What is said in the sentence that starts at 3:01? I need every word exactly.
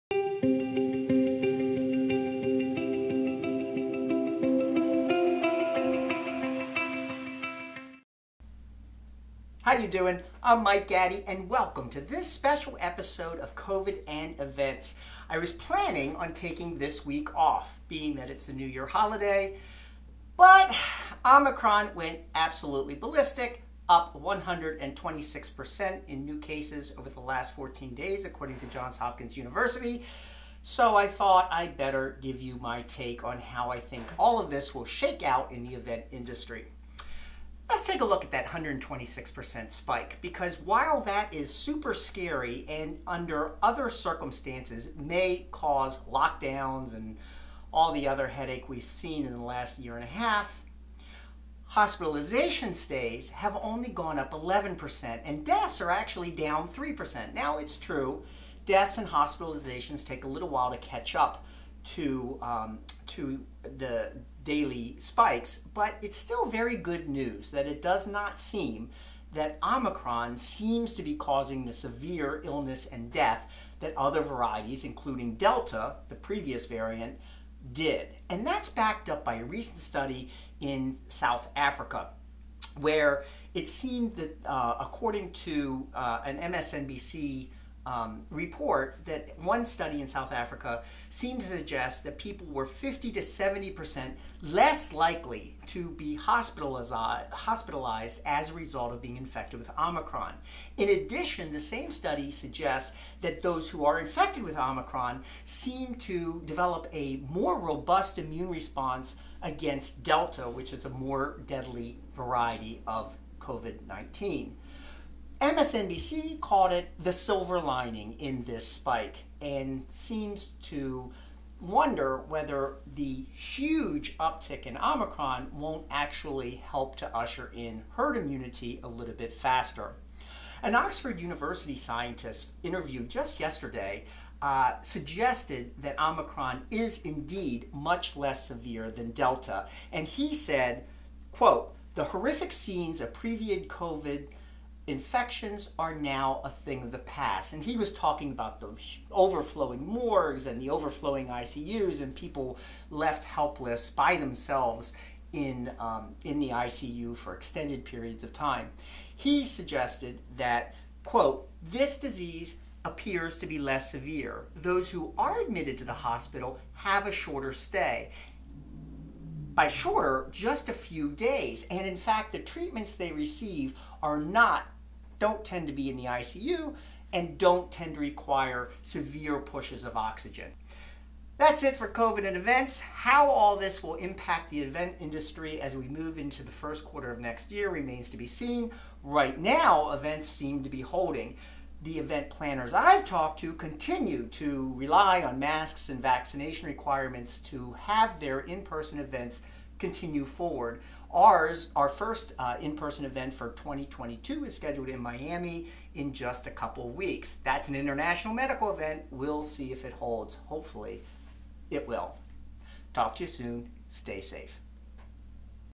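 That's it for COVID and events.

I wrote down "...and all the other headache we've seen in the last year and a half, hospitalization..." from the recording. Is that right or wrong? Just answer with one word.
right.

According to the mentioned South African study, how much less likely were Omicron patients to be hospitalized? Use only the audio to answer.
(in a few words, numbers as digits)
50 to 70 percent.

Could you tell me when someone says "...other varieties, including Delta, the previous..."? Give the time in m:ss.
1:13.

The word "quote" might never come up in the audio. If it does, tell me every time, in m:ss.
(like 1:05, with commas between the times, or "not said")
2:21, 2:41.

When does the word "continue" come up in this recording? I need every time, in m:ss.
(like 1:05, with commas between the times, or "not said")
3:13, 3:19.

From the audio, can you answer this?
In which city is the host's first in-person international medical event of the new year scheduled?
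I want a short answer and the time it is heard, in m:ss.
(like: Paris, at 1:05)
Miami, at 3:25.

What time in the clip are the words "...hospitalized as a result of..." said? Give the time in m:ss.
1:36.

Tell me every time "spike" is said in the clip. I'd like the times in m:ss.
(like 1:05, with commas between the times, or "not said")
0:39, 1:04, 1:58.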